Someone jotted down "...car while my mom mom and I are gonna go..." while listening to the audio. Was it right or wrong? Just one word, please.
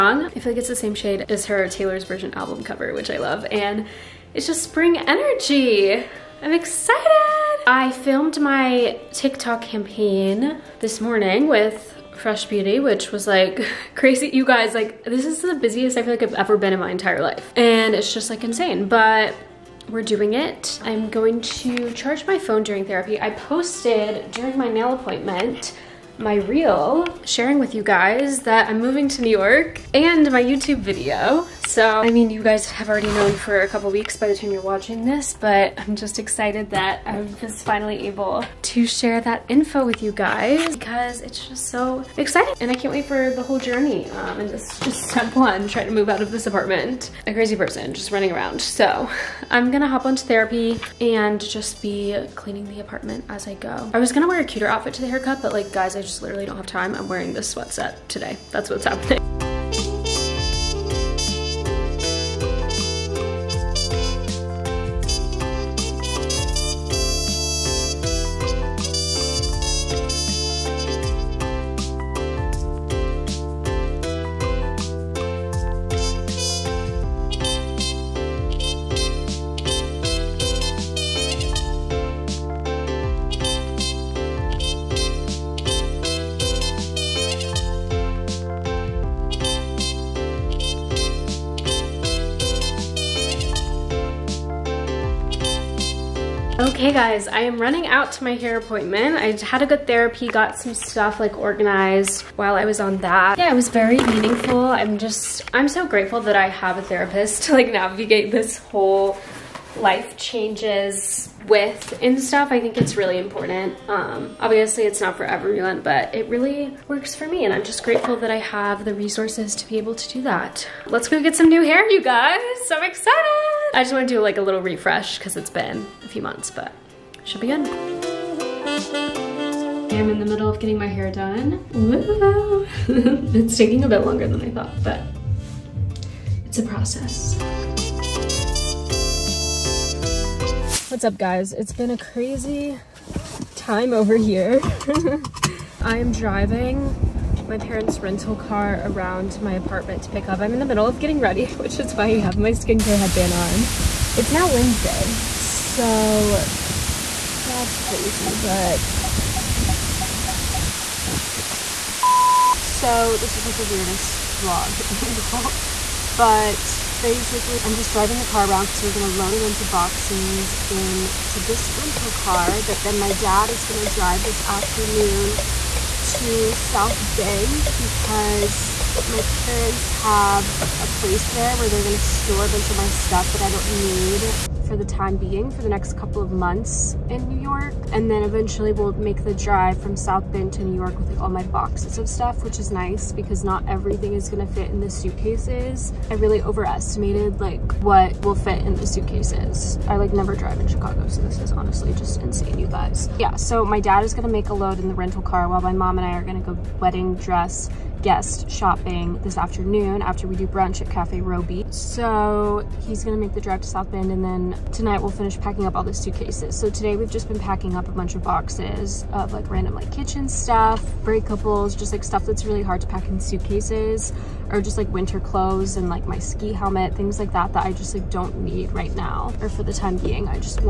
right.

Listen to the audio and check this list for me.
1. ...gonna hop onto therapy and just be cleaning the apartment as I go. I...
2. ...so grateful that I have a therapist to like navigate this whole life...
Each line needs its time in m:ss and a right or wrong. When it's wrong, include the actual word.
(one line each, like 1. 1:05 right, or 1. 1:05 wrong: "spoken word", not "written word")
1. 0:49 right
2. 1:45 right.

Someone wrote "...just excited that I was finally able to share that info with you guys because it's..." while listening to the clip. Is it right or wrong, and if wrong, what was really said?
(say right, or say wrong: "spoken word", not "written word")
right.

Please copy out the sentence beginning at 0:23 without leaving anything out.
I posted during my nail appointment my reel sharing with you guys that I'm moving to New York and my YouTube video.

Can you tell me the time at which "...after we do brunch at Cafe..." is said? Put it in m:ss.
3:30.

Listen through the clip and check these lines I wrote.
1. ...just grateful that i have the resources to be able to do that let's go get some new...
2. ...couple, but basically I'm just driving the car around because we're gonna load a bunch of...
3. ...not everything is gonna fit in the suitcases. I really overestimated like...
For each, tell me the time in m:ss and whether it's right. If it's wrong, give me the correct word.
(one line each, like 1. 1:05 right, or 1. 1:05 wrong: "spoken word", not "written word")
1. 1:57 right
2. 2:45 wrong: "angle", not "couple"
3. 3:13 right.